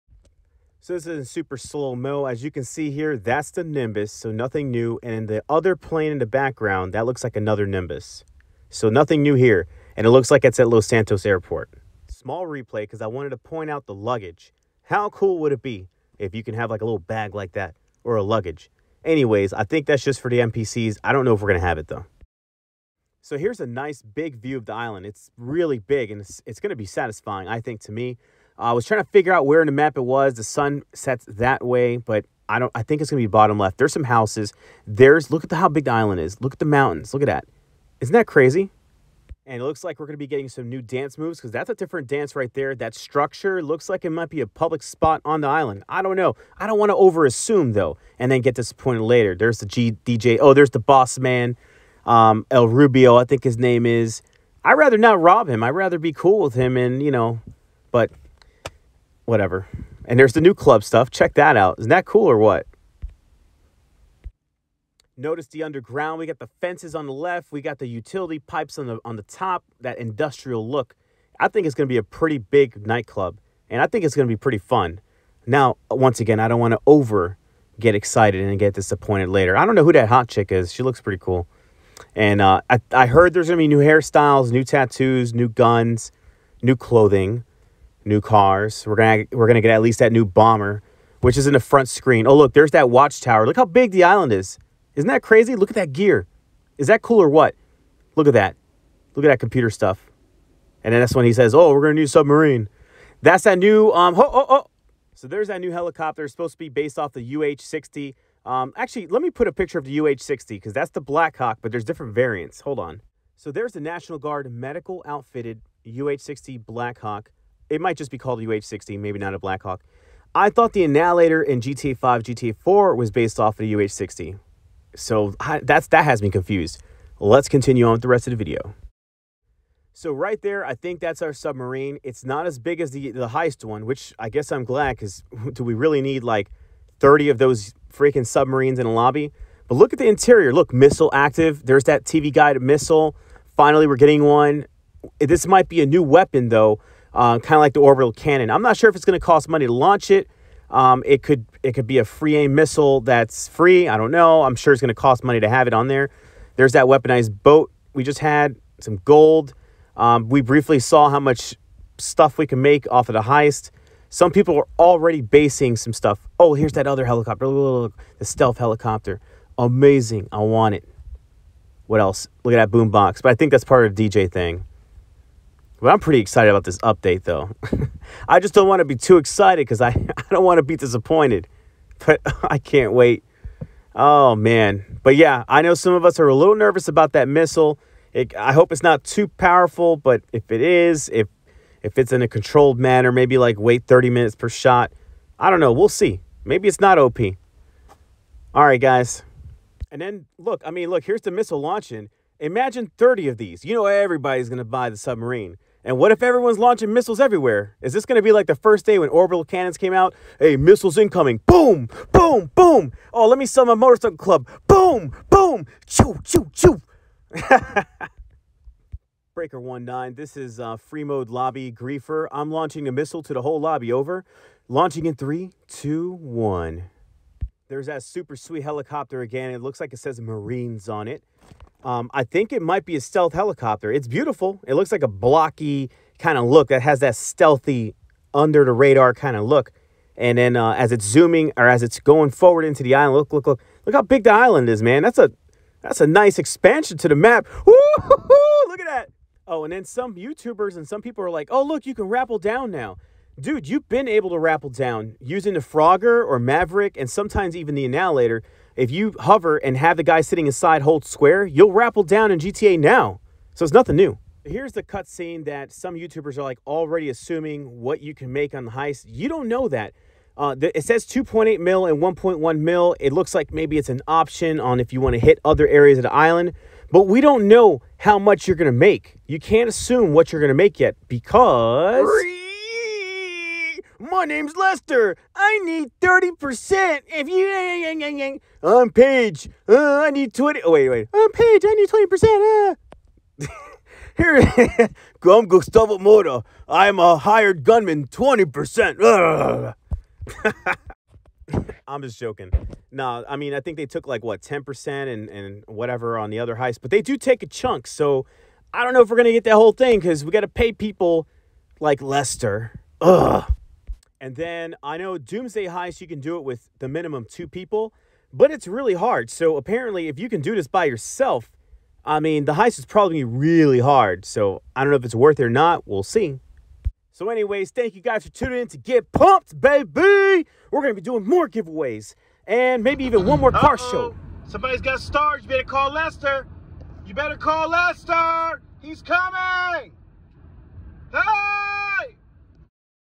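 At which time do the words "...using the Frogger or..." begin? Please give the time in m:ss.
4:15.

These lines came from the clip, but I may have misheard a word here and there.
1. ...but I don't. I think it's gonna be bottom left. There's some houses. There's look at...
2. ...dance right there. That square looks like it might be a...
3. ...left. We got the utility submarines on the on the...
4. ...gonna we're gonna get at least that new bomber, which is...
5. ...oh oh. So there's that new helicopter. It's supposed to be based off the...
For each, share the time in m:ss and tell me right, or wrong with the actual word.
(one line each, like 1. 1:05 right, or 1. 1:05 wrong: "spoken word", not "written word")
1. 0:31 right
2. 0:42 wrong: "structure", not "square"
3. 1:07 wrong: "pipes", not "submarines"
4. 1:28 right
5. 1:44 right.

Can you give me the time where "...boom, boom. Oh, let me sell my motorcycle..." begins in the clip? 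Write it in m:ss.
3:32.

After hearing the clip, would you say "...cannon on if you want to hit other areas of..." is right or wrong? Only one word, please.
wrong.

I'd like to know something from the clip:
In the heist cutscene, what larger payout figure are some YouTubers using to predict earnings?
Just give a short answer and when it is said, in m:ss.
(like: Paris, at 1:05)
2.8 million, at 4:31.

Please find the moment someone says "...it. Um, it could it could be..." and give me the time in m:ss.
2:30.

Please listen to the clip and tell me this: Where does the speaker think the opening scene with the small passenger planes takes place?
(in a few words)
Los Santos Airport.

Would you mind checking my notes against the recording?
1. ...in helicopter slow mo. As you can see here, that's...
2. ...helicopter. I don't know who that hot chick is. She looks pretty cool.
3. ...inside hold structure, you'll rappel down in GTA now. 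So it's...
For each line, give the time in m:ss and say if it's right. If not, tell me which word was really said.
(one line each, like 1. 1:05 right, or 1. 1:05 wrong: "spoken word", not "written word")
1. 0:01 wrong: "super", not "helicopter"
2. 1:19 wrong: "later", not "helicopter"
3. 4:20 wrong: "square", not "structure".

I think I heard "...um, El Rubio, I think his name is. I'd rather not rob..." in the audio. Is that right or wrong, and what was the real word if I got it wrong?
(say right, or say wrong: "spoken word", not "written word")
right.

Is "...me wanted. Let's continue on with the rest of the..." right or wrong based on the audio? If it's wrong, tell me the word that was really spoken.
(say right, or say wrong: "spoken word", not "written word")
wrong: "confused", not "wanted".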